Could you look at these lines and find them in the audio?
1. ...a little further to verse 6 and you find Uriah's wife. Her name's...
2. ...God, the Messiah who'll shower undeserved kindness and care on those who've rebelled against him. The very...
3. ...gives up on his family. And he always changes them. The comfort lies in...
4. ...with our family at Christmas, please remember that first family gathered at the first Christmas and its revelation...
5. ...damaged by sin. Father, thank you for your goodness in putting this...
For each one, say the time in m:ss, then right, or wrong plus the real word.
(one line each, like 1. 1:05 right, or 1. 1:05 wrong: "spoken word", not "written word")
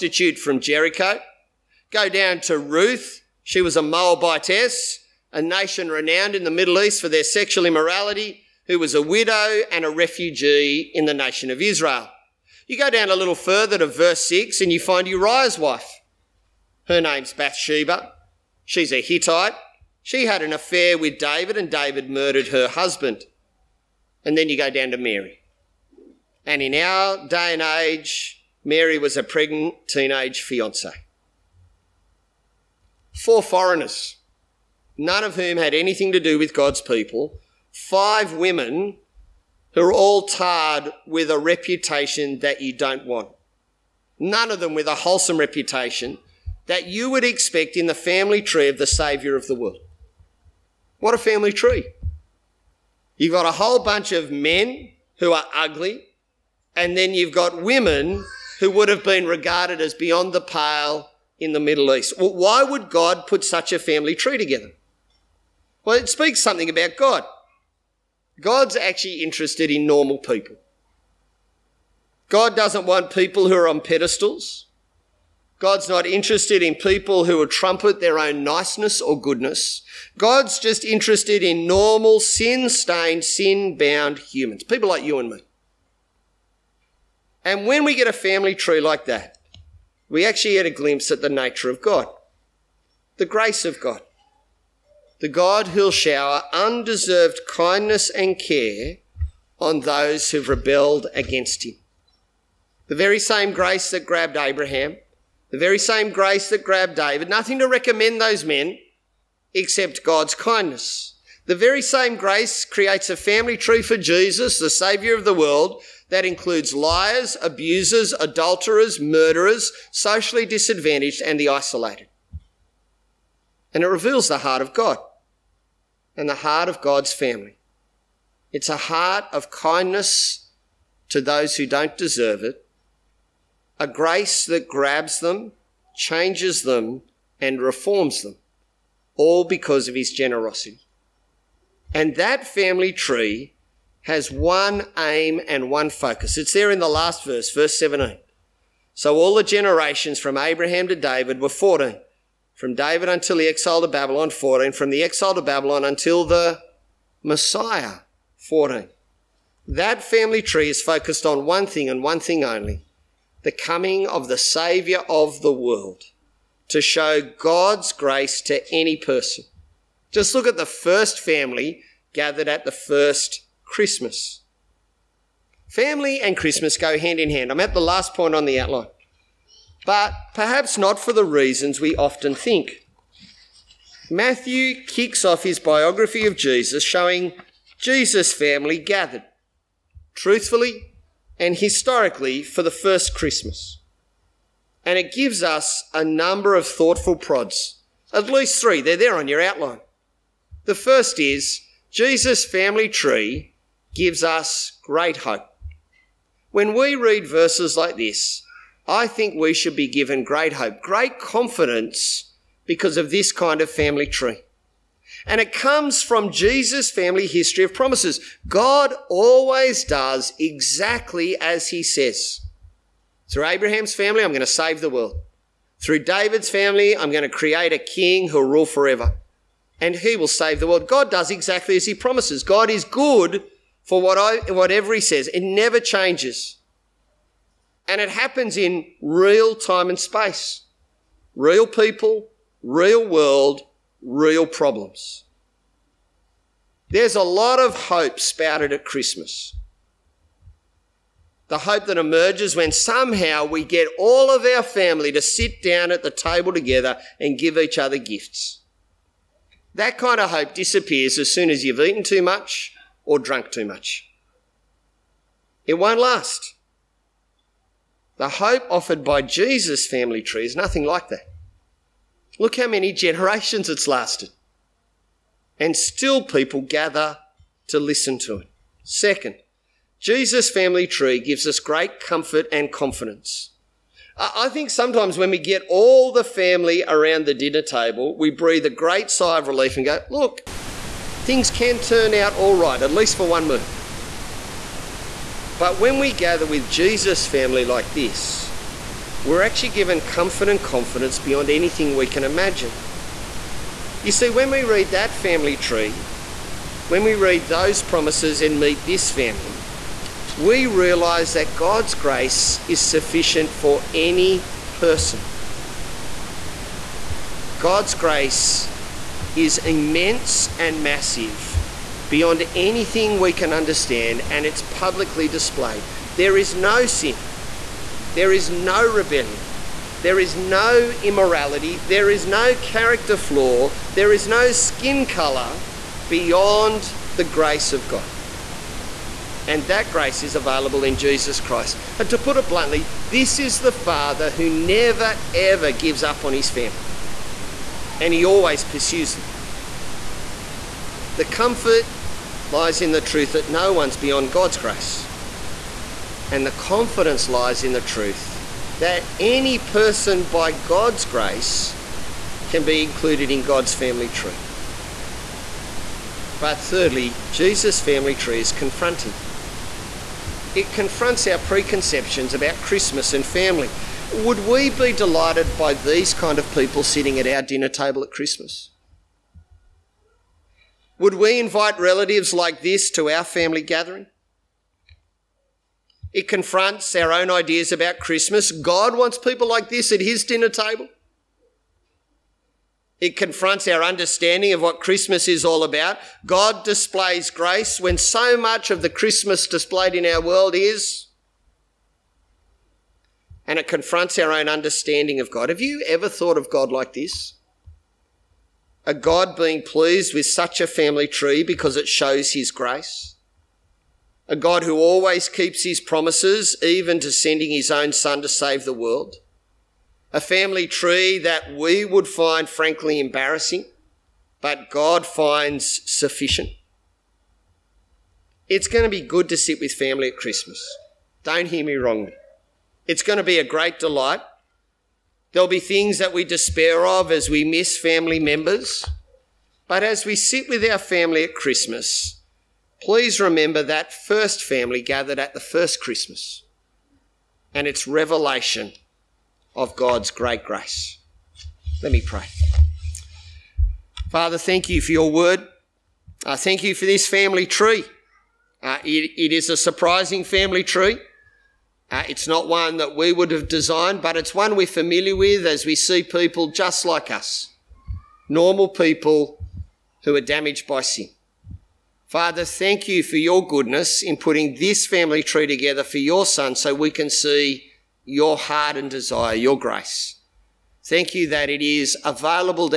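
1. 0:13 right
2. 1:33 wrong: "God", not "Messiah"
3. 5:45 wrong: "pursues", not "changes"
4. 7:20 right
5. 7:50 right.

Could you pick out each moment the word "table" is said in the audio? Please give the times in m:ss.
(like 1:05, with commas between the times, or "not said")
4:16, 4:47, 6:17, 6:30.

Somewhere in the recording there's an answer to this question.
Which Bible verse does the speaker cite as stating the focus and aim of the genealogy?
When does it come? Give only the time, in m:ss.
2:27.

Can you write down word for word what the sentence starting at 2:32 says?
From David until the exile to Babylon, 14.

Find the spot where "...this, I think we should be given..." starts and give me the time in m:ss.
3:27.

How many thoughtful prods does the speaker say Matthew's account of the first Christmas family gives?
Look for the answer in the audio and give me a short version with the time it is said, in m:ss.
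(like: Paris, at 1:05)
3, at 3:18.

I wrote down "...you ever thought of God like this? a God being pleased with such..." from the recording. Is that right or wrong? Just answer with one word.
right.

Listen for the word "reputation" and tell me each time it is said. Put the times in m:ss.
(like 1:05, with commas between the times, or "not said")
0:41, 0:45.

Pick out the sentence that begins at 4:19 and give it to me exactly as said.
That kind of hope disappears as soon as you've eaten too much, or drunk too much.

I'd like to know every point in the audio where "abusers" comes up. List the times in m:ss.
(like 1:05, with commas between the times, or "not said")
1:57.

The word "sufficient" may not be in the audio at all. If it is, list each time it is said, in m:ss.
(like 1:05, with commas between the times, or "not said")
5:12, 7:05.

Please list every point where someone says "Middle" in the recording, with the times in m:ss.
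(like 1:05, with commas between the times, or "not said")
0:06, 1:01.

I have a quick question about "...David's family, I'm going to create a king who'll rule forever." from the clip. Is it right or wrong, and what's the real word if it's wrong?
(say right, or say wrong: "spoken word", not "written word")
right.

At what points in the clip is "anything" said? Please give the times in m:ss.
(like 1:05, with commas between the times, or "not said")
0:35, 5:01, 5:22.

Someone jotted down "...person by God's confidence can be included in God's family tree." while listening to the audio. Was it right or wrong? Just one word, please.
wrong.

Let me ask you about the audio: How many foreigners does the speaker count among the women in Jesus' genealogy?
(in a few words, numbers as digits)
4.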